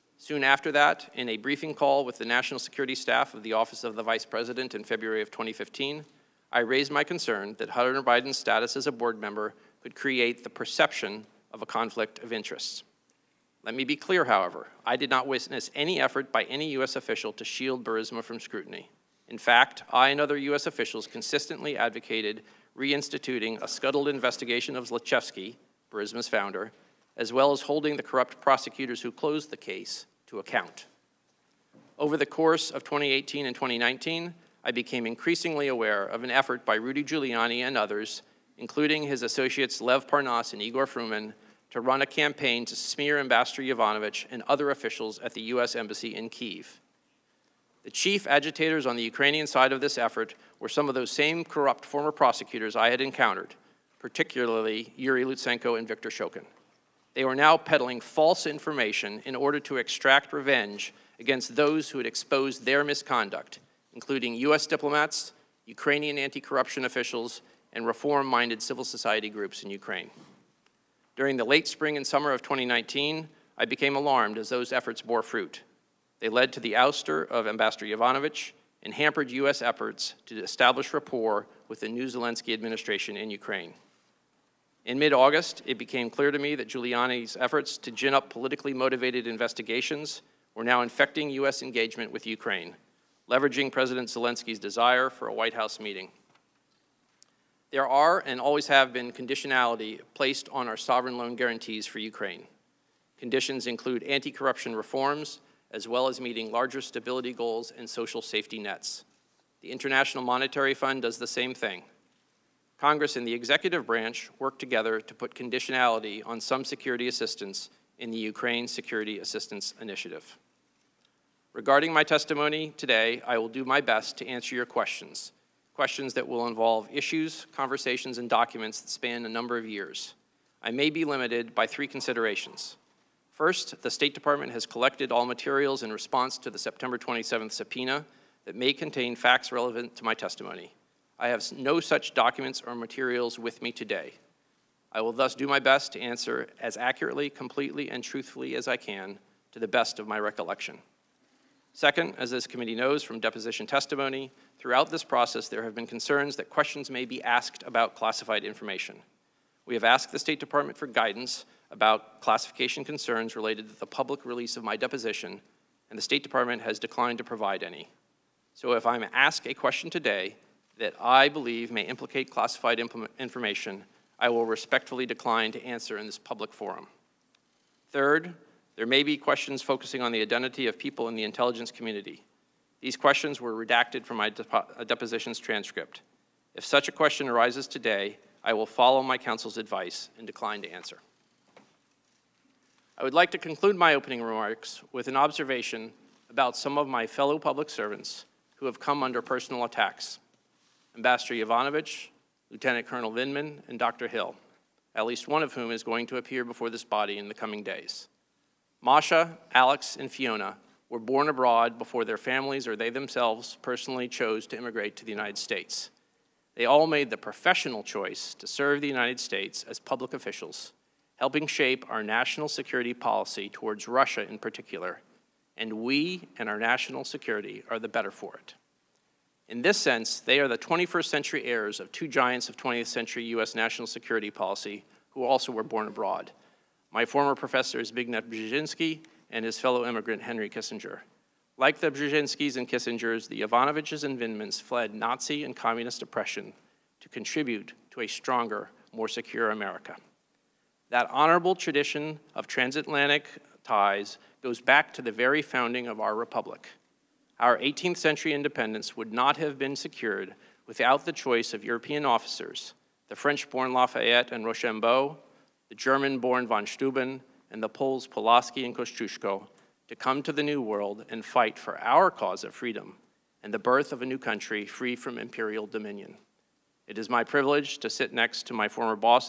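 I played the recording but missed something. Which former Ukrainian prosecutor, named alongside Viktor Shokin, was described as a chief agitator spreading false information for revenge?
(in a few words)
Yuri Lutsenko.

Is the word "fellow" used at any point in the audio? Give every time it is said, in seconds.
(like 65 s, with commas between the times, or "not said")
197 s, 239 s.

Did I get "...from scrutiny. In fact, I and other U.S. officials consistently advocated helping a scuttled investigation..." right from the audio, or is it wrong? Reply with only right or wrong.
wrong.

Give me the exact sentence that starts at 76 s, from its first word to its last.
They led to the ouster of Ambassador Yovanovitch and hampered U.S.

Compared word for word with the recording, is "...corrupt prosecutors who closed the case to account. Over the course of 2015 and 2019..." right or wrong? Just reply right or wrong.
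wrong.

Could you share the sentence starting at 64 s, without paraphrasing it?
diplomats, Ukrainian anti-corruption officials, and reform-minded civil society groups in Ukraine.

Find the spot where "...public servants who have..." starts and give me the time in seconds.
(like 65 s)
197 s.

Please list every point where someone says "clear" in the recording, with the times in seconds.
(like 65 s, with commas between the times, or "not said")
13 s, 86 s.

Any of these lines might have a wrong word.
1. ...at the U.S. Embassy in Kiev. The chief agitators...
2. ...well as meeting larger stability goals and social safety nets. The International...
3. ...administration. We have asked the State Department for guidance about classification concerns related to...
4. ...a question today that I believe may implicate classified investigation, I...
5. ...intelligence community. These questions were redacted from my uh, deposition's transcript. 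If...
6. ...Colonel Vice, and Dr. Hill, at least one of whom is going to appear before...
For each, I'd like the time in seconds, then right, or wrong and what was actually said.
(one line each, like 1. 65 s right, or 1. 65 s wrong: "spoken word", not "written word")
1. 45 s right
2. 105 s right
3. 158 s wrong: "information", not "administration"
4. 169 s wrong: "information", not "investigation"
5. 181 s right
6. 202 s wrong: "Vindman", not "Vice".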